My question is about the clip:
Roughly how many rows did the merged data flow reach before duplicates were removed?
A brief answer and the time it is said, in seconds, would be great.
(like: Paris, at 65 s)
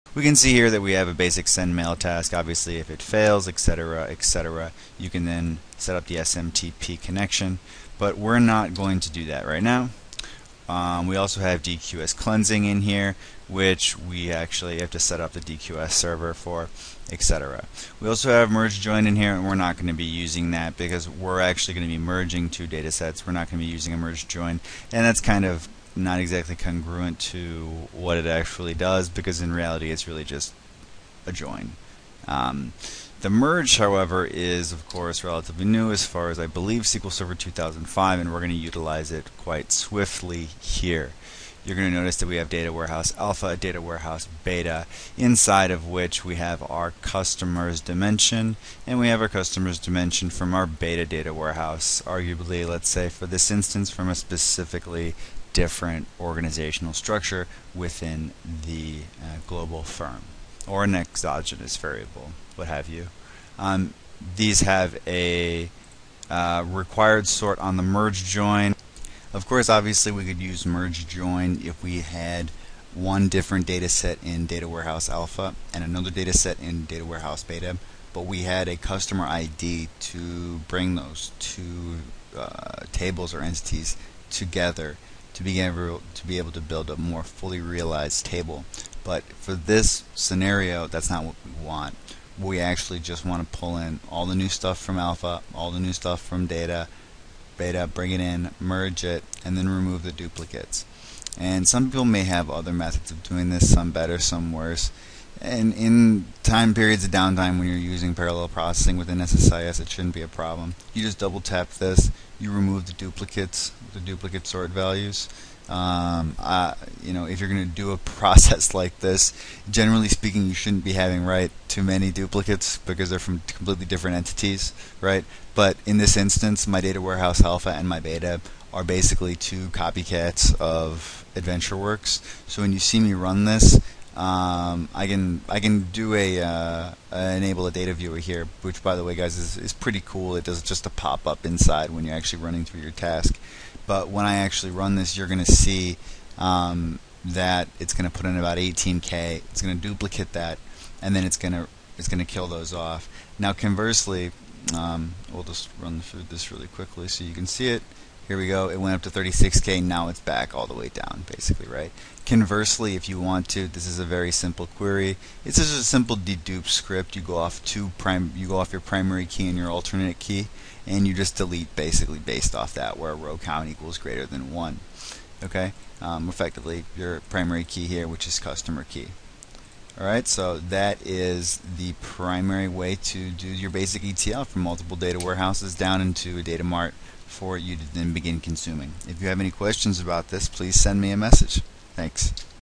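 36K, at 159 s.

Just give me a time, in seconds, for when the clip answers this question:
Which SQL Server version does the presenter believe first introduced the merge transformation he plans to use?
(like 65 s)
36 s.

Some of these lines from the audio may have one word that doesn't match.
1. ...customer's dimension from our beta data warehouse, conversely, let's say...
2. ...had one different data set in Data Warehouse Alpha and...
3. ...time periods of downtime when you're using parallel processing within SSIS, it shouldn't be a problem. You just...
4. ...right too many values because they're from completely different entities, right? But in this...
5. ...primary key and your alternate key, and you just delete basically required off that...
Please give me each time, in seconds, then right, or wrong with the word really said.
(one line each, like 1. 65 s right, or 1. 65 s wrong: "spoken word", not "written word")
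1. 49 s wrong: "arguably", not "conversely"
2. 72 s right
3. 106 s right
4. 121 s wrong: "duplicates", not "values"
5. 168 s wrong: "based", not "required".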